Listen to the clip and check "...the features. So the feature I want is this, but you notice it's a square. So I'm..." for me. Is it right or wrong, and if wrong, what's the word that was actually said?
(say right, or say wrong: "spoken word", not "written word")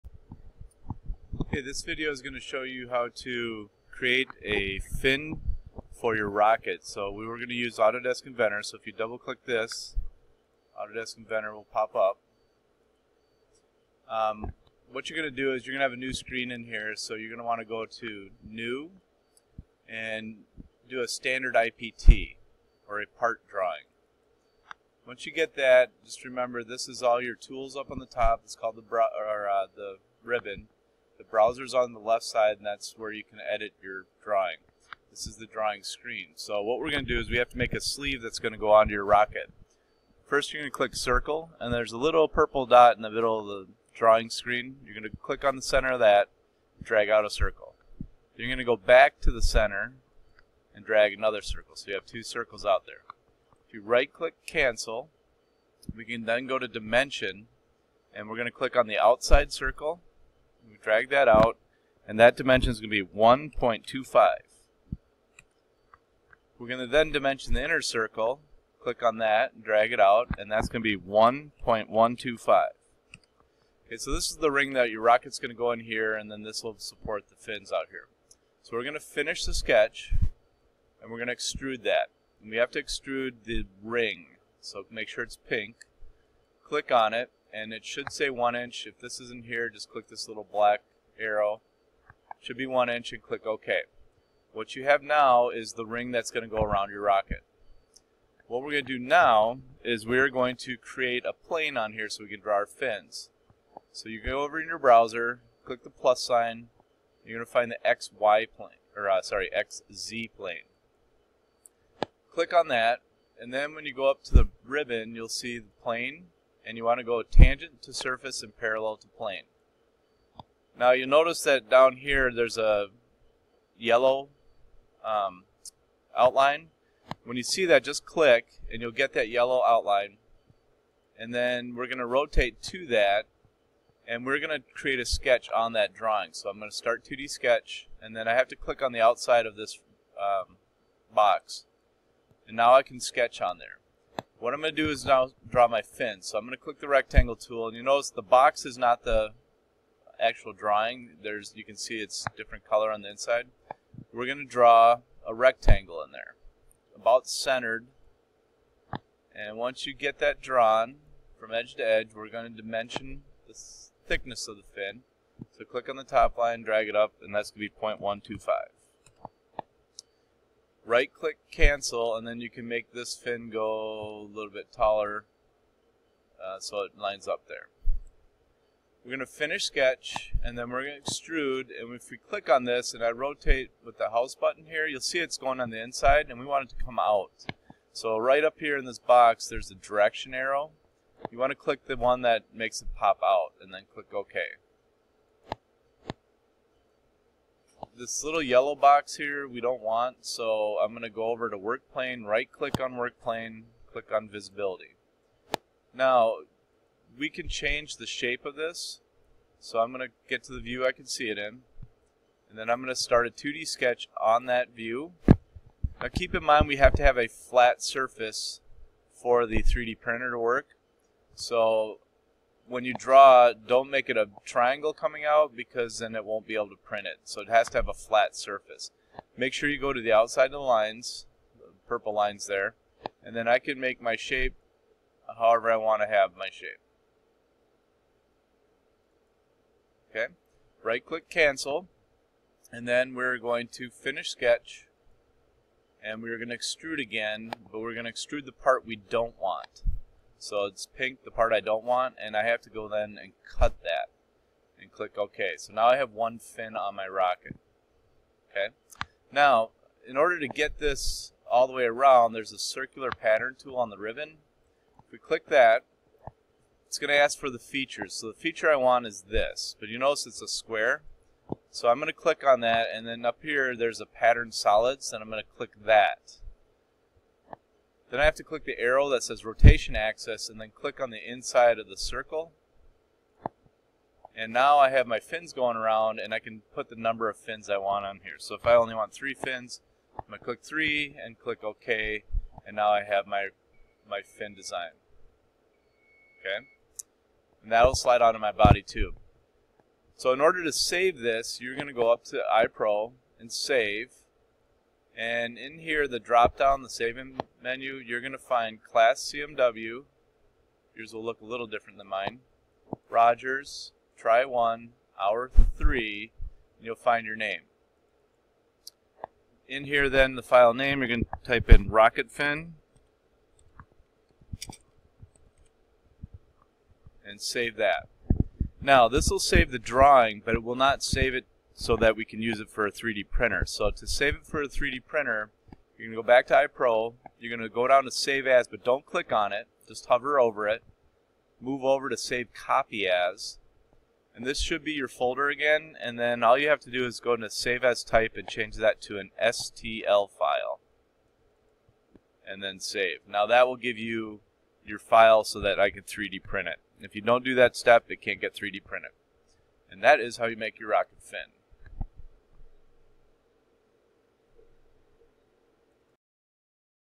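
right.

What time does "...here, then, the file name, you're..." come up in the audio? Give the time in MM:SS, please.
05:19.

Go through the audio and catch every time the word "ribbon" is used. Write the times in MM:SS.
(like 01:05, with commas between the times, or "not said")
00:30, 01:54, 04:23.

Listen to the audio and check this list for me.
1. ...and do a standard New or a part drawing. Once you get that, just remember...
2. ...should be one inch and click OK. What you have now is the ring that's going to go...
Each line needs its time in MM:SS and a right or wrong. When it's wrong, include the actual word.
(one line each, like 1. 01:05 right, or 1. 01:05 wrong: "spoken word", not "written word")
1. 00:19 wrong: "IPT", not "New"
2. 01:32 right.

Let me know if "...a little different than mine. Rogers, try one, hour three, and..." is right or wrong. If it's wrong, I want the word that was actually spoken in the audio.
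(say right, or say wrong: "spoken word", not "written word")
right.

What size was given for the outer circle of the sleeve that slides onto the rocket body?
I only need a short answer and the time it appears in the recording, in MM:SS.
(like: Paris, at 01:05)
1.25, at 01:03.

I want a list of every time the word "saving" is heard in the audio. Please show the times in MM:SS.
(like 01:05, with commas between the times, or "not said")
05:06.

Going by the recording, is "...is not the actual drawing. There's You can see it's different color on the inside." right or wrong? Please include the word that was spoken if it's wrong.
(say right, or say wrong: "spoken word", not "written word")
right.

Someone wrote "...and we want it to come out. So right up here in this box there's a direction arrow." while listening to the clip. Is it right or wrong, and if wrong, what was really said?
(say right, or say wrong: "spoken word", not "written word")
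right.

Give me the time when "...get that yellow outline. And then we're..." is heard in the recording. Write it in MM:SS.
02:08.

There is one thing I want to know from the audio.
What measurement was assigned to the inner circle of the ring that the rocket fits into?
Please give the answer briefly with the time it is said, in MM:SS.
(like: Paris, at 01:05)
1.125, at 01:11.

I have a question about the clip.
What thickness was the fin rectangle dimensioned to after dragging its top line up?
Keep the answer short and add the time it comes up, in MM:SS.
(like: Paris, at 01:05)
0.125, at 02:47.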